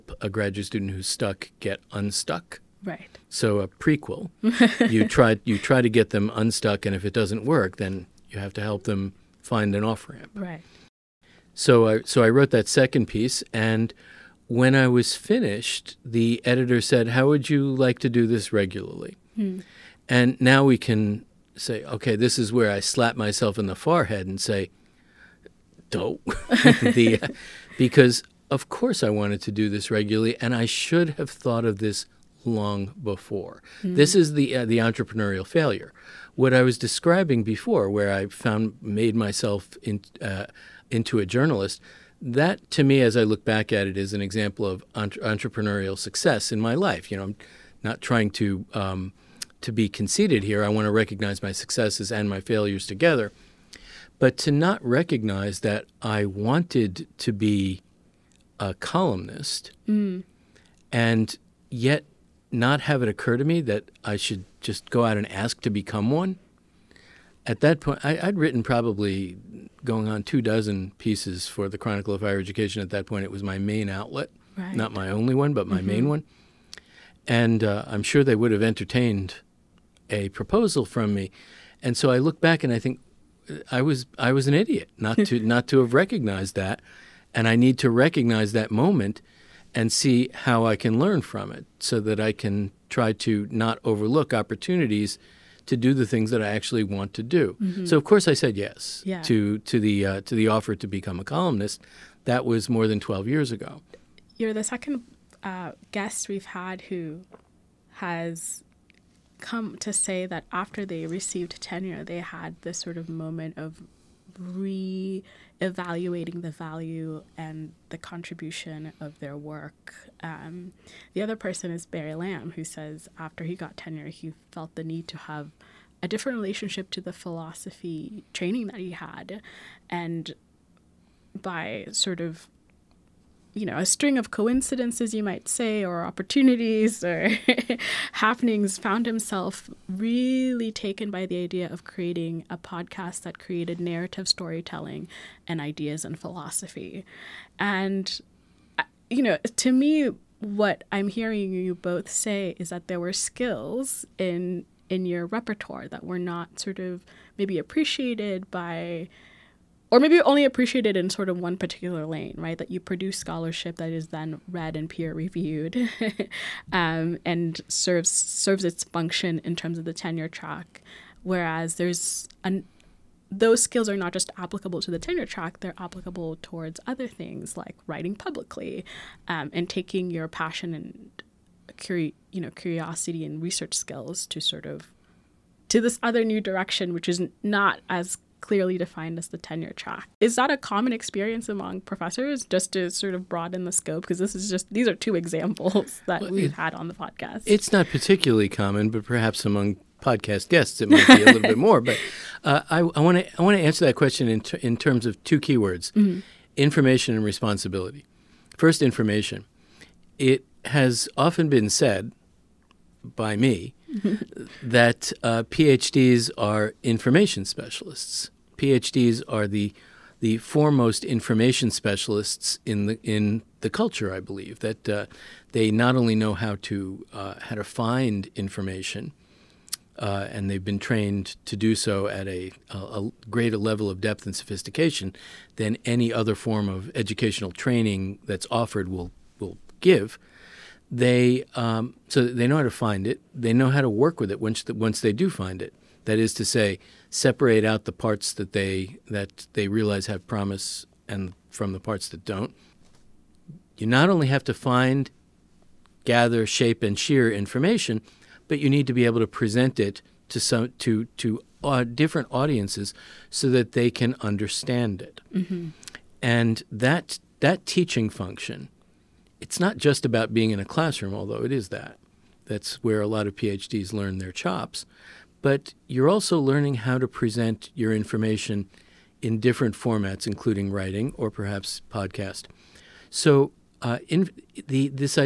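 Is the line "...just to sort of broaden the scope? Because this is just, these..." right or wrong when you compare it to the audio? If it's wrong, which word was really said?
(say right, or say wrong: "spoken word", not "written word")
right.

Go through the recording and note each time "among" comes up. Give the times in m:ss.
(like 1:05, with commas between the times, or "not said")
3:11, 3:19.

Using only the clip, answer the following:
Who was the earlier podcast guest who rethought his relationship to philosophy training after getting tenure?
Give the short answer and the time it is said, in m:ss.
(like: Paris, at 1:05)
Barry Lam, at 2:01.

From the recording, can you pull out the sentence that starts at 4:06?
That is to say, separate out the parts that they that they realize have promise and from the parts that don't.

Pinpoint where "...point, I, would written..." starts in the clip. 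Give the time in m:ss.
1:07.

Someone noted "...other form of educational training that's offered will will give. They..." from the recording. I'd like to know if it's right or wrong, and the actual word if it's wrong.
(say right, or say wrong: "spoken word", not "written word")
right.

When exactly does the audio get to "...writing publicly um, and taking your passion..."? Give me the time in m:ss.
2:57.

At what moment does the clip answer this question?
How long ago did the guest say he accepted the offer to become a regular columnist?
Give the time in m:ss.
1:42.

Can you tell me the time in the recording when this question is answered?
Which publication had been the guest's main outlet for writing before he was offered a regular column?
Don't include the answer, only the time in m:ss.
1:11.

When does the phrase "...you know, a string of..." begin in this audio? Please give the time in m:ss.
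2:13.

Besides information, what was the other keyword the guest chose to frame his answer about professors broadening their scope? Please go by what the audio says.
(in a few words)
Responsibility.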